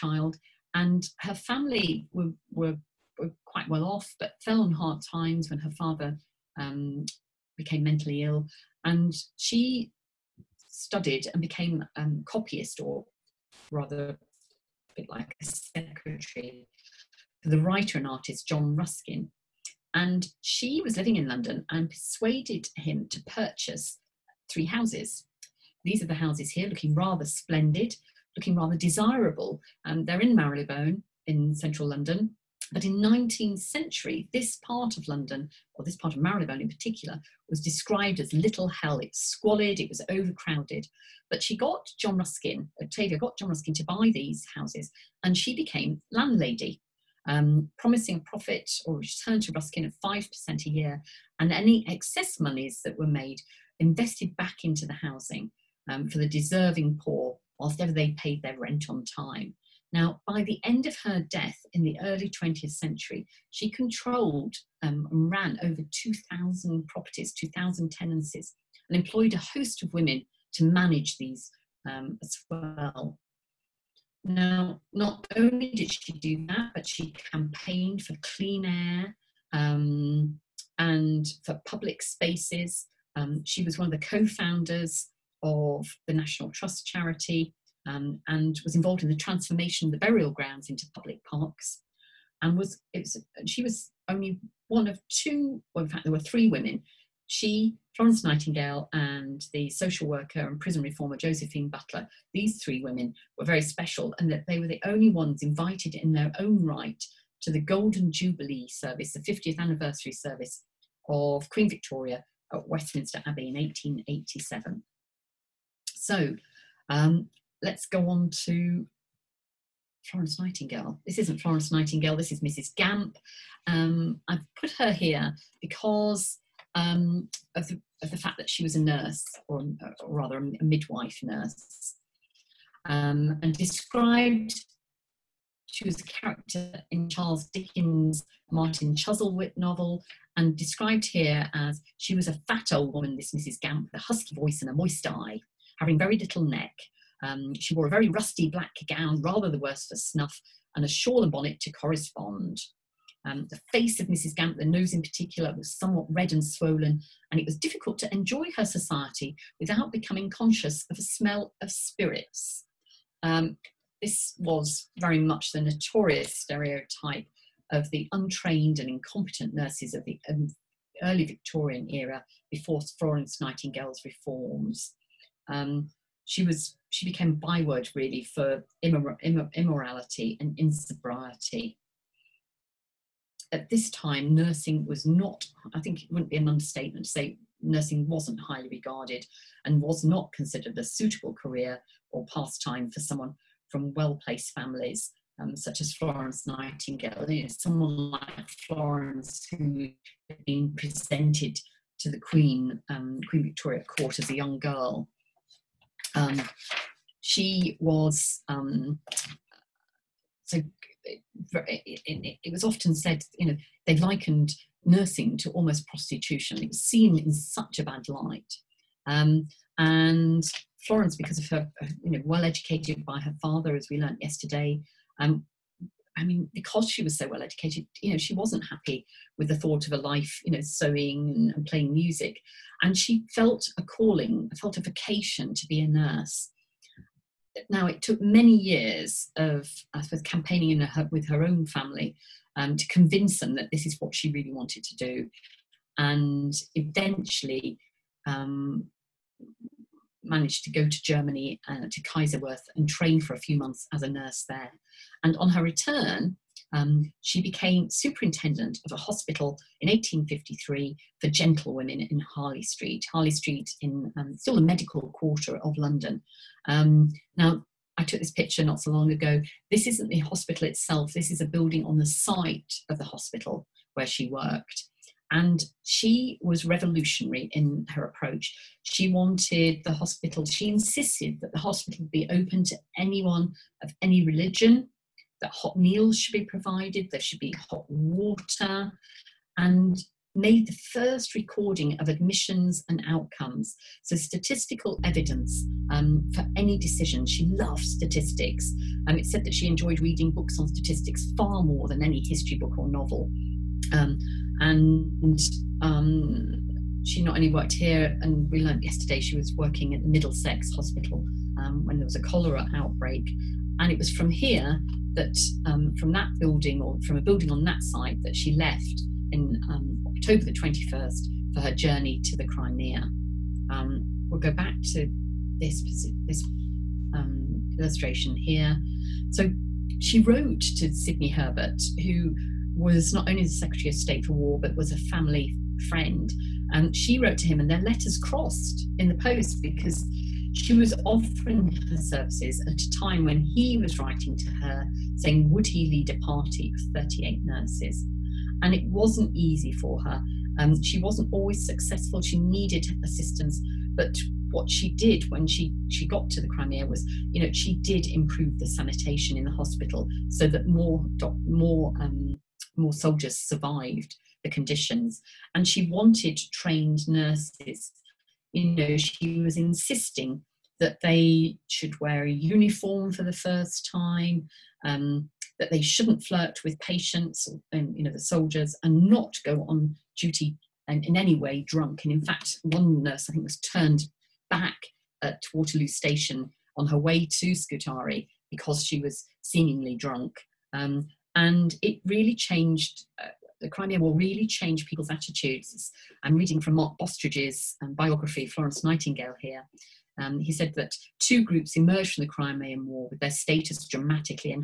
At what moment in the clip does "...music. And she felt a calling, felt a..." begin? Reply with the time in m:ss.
3:51.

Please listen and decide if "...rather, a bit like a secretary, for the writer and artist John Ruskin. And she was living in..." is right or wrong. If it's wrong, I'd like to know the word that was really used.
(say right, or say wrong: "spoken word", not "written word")
right.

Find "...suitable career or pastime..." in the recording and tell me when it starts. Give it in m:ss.
3:10.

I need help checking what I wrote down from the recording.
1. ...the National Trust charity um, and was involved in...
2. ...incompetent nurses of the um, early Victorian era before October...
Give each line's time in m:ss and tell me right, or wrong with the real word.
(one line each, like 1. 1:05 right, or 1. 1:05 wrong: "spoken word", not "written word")
1. 1:26 right
2. 2:48 wrong: "Florence", not "October".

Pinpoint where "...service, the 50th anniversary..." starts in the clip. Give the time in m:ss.
1:48.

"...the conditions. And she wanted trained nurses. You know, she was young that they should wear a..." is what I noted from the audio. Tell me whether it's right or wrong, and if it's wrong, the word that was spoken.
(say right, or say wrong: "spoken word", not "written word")
wrong: "insisting", not "young".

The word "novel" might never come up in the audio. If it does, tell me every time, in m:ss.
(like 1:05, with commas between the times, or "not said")
2:19, 5:02.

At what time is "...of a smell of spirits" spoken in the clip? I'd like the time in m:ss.
2:40.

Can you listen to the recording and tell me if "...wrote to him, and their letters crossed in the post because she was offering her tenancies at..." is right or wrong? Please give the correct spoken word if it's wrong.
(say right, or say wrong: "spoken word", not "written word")
wrong: "services", not "tenancies".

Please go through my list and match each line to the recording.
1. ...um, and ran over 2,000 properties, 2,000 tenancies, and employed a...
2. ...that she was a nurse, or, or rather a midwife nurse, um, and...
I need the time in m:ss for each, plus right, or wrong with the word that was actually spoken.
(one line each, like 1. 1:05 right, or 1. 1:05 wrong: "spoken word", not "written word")
1. 1:04 right
2. 2:08 right.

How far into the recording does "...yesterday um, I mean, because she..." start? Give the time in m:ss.
3:44.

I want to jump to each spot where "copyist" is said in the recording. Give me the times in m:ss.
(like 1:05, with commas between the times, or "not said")
0:12.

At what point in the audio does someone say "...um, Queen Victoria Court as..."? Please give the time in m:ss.
3:22.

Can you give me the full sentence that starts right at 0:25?
These are the houses here, looking rather splendid, looking rather desirable.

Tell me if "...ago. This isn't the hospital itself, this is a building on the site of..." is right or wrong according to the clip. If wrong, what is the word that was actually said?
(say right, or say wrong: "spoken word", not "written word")
right.